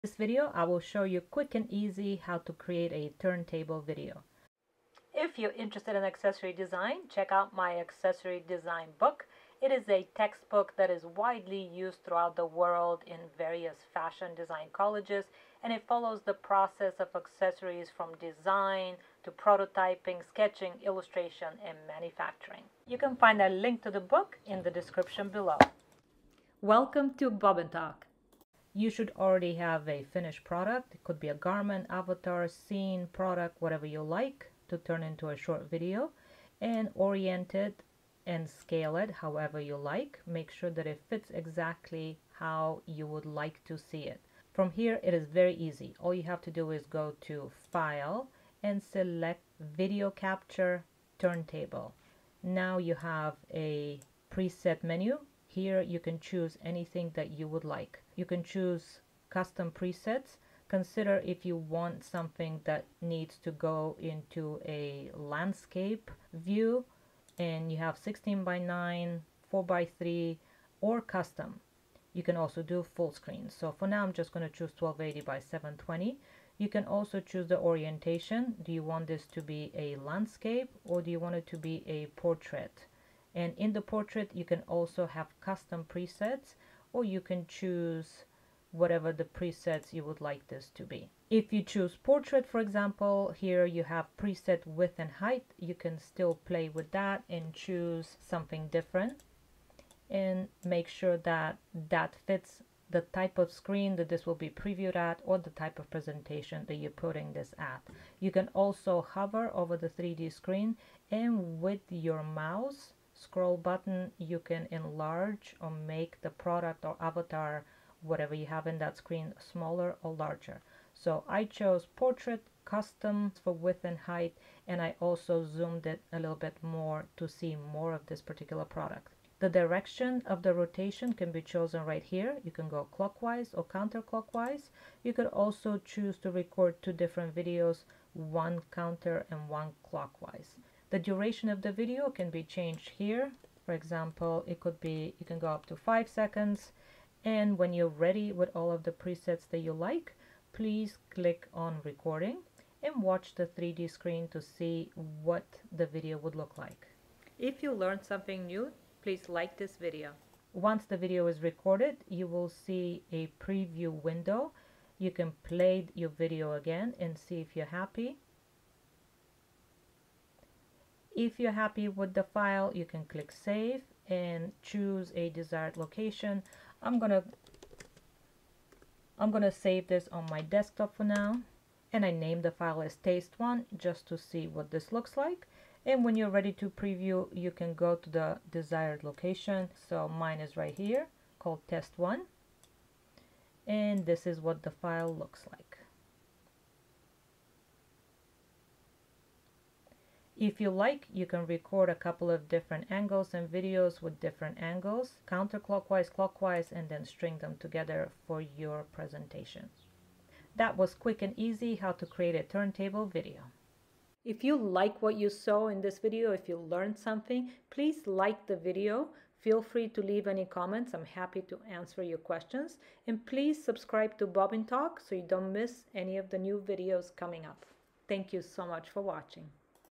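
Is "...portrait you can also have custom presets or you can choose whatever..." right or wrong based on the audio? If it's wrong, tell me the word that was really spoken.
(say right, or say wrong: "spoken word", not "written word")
right.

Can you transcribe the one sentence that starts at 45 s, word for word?
All you have to do is go to File and select Video Capture Turntable.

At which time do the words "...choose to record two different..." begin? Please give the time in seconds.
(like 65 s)
135 s.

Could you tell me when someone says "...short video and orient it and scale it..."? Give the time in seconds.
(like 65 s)
35 s.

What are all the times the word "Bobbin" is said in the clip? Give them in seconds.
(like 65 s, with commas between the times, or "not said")
27 s, 224 s.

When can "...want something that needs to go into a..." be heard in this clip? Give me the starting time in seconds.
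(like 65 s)
61 s.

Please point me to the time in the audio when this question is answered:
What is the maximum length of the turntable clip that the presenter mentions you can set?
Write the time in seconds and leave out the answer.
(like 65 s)
145 s.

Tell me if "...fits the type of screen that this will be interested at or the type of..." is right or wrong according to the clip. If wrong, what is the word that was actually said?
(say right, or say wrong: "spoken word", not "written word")
wrong: "previewed", not "interested".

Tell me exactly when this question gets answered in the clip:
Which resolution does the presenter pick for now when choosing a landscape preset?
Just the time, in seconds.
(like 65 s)
74 s.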